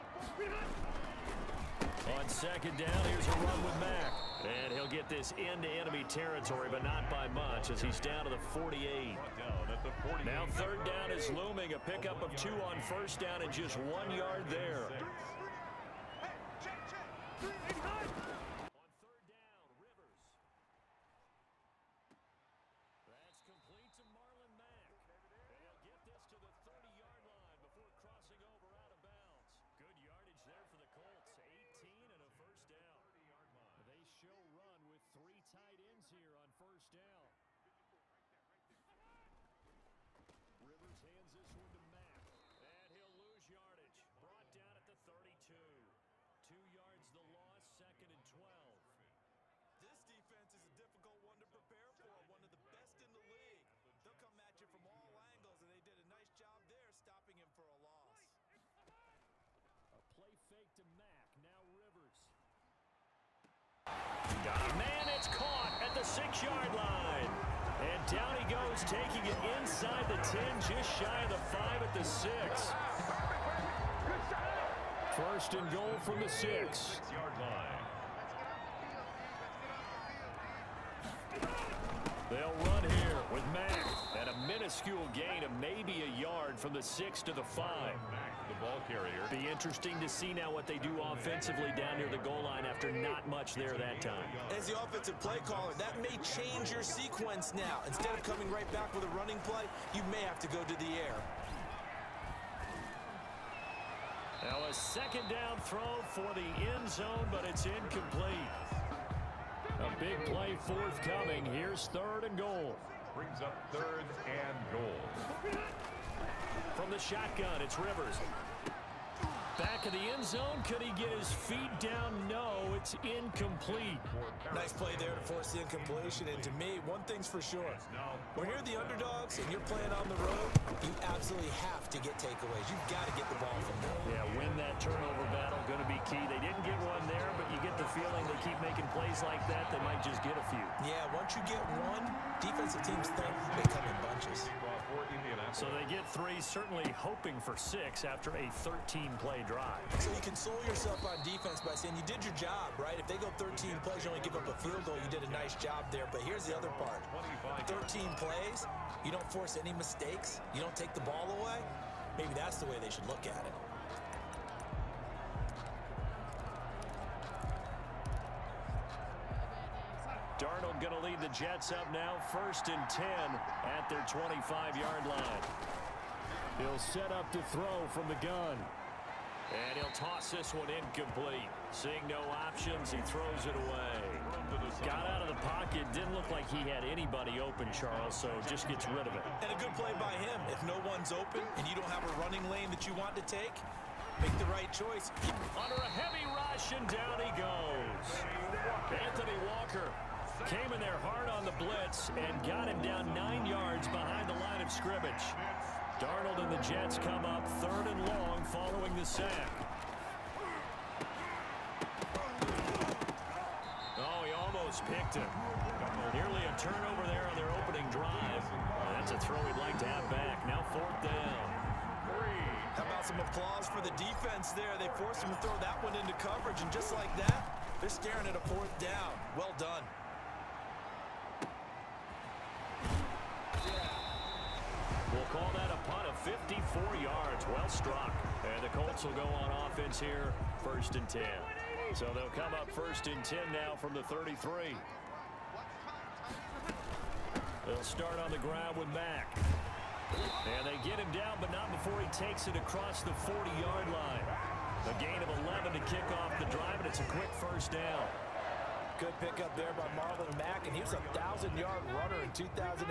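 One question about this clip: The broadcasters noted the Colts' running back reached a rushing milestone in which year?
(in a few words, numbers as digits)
2019.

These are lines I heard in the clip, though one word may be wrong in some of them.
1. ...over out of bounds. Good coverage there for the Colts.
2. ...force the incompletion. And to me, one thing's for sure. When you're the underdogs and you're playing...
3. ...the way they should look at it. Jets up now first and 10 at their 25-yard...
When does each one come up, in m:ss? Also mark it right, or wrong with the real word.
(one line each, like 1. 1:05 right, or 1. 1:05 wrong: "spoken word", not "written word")
1. 0:28 wrong: "yardage", not "coverage"
2. 2:05 right
3. 2:42 right.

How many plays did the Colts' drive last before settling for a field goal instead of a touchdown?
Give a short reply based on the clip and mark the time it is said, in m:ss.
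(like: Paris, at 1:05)
13, at 2:28.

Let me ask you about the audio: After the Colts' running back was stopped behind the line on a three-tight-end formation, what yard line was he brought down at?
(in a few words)
32.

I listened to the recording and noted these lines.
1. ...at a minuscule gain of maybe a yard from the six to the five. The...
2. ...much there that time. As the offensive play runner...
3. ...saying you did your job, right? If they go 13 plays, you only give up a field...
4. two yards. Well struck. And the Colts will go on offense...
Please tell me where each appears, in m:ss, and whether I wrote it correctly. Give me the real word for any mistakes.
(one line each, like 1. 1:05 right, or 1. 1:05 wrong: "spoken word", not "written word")
1. 1:24 right
2. 1:33 wrong: "caller", not "runner"
3. 2:31 right
4. 3:56 wrong: "four", not "two".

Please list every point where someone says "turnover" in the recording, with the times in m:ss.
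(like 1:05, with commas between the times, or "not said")
2:14, 3:36.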